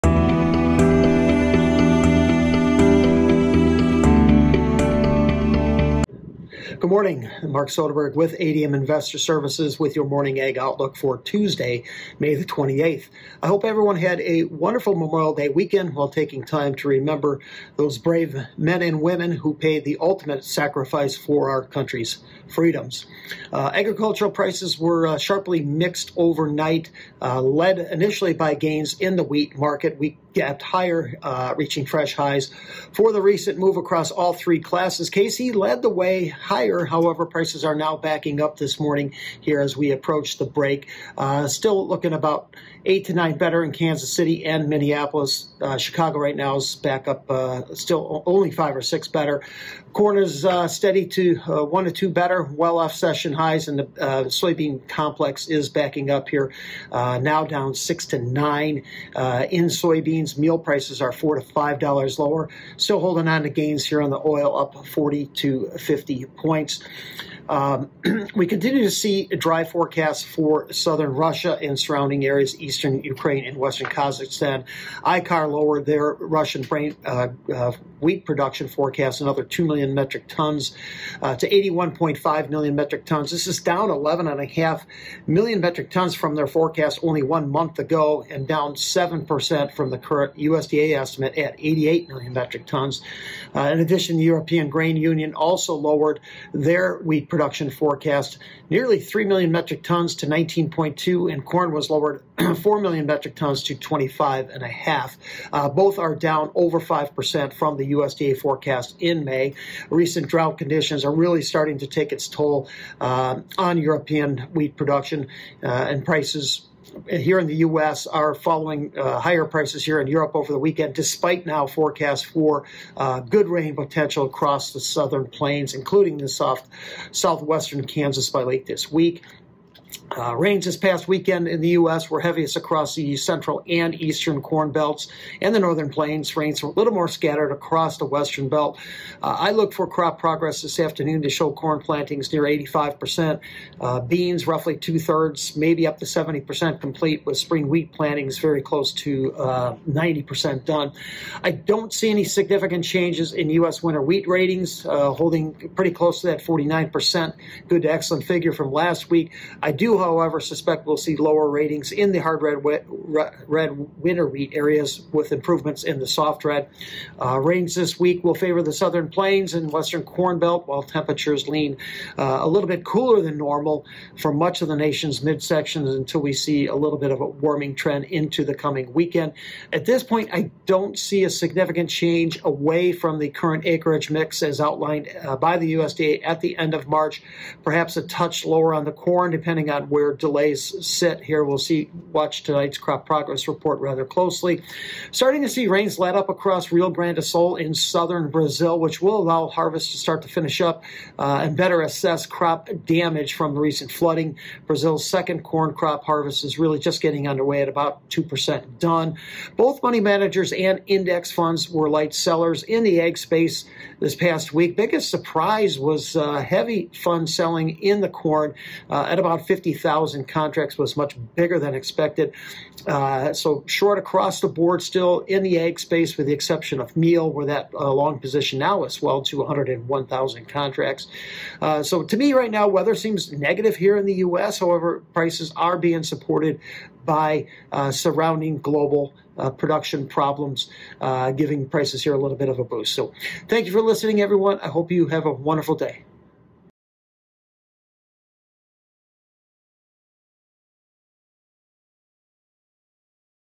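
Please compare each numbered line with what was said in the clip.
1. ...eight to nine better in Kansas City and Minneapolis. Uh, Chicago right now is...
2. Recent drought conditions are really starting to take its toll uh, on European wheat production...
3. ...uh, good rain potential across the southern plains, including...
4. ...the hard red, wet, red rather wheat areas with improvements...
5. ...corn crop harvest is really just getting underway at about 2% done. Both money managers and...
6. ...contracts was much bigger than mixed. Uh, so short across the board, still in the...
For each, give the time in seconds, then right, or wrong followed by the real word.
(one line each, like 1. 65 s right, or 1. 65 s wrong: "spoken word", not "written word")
1. 42 s right
2. 109 s right
3. 122 s right
4. 162 s wrong: "winter", not "rather"
5. 205 s right
6. 220 s wrong: "expected", not "mixed".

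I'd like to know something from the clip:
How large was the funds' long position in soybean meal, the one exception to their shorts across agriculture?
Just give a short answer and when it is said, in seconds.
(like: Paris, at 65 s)
101,000 contracts, at 229 s.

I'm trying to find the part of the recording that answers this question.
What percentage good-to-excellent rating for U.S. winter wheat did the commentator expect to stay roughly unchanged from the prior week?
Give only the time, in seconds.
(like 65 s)
156 s.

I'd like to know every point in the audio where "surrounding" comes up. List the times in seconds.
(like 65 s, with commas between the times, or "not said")
71 s, 237 s.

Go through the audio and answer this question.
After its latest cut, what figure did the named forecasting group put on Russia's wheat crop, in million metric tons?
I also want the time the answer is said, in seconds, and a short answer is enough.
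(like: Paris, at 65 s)
81.5, at 81 s.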